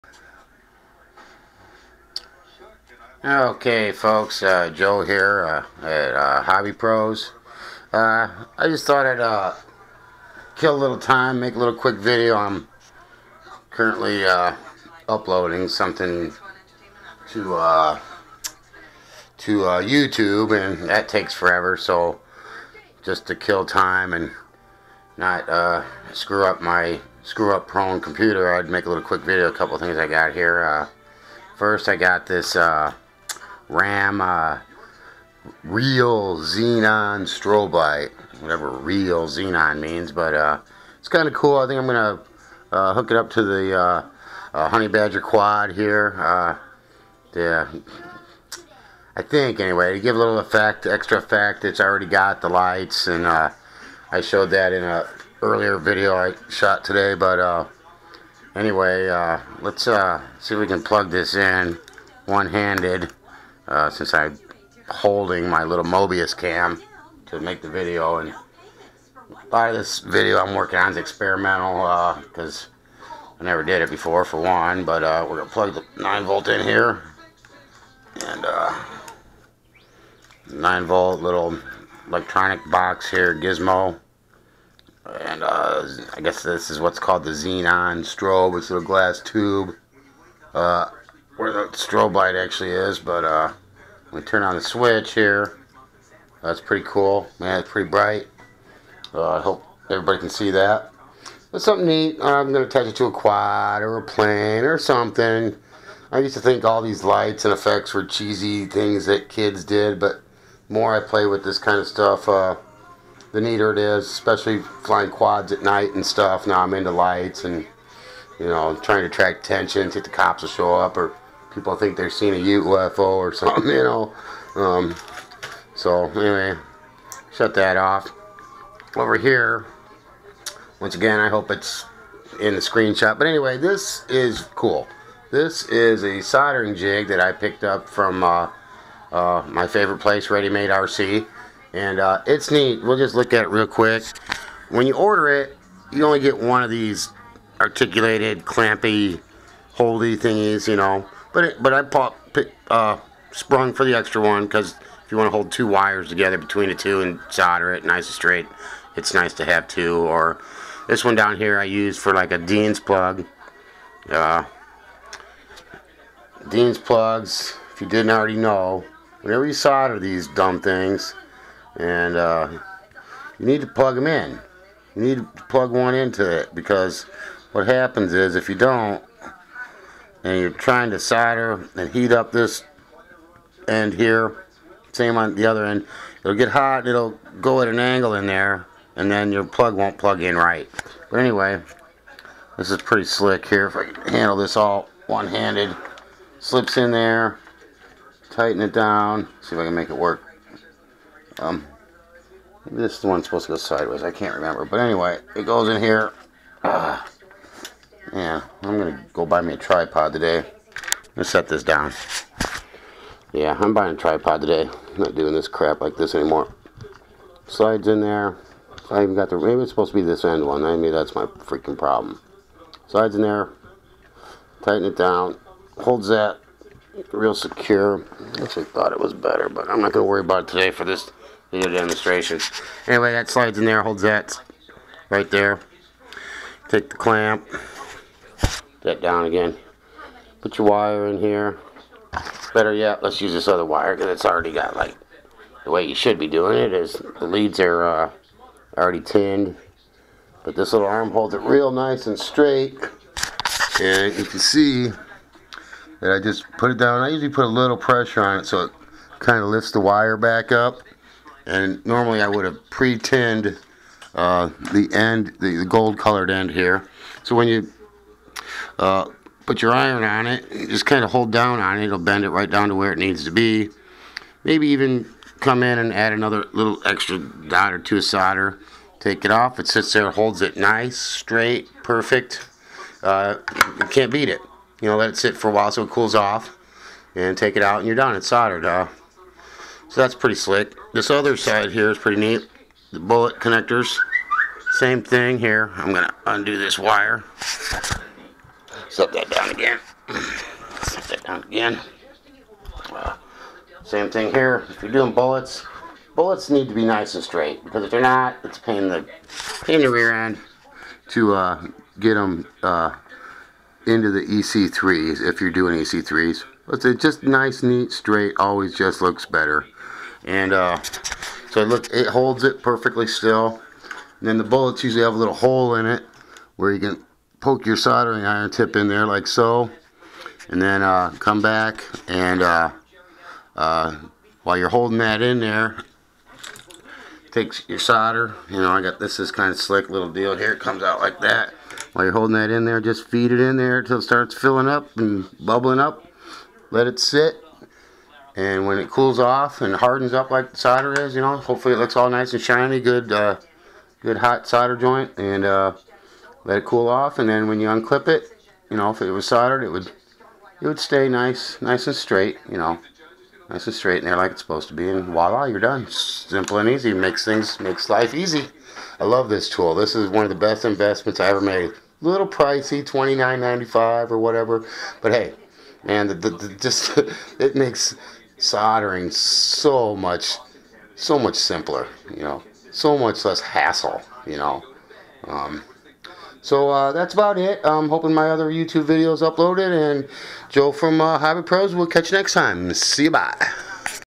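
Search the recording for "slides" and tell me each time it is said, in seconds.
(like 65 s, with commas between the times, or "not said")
217 s, 222 s, 233 s.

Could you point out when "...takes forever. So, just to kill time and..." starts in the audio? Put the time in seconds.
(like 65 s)
21 s.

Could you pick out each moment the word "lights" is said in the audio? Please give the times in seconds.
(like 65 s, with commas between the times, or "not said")
37 s, 52 s, 92 s, 107 s, 116 s.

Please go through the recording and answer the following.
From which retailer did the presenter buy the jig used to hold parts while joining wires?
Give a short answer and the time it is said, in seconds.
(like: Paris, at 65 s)
Ready Made RC, at 140 s.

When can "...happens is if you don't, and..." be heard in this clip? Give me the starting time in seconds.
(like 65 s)
177 s.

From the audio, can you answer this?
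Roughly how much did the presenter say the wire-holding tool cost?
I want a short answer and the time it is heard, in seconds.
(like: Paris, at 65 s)
$29.95, at 372 s.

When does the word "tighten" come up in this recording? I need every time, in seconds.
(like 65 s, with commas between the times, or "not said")
198 s, 224 s.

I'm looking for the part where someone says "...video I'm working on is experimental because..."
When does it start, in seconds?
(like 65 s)
69 s.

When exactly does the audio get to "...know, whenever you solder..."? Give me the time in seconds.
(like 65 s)
168 s.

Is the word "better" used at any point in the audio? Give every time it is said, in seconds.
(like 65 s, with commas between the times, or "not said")
229 s, 242 s, 319 s.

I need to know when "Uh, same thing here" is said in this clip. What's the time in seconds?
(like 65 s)
302 s.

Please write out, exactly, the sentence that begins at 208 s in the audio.
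Yeah, I'm gonna go buy me a tripod today.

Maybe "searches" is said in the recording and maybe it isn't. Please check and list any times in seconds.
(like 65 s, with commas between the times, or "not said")
not said.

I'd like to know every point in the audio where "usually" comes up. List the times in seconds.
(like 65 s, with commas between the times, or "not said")
257 s, 324 s.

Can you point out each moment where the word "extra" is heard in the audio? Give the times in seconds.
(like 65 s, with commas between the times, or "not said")
50 s, 153 s, 276 s.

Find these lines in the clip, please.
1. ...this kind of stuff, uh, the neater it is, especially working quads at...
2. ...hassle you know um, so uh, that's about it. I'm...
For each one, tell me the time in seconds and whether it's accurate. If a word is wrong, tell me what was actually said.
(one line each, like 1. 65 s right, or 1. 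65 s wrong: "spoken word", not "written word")
1. 111 s wrong: "flying", not "working"
2. 383 s right.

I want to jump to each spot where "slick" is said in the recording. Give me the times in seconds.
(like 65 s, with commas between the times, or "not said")
193 s, 290 s, 339 s.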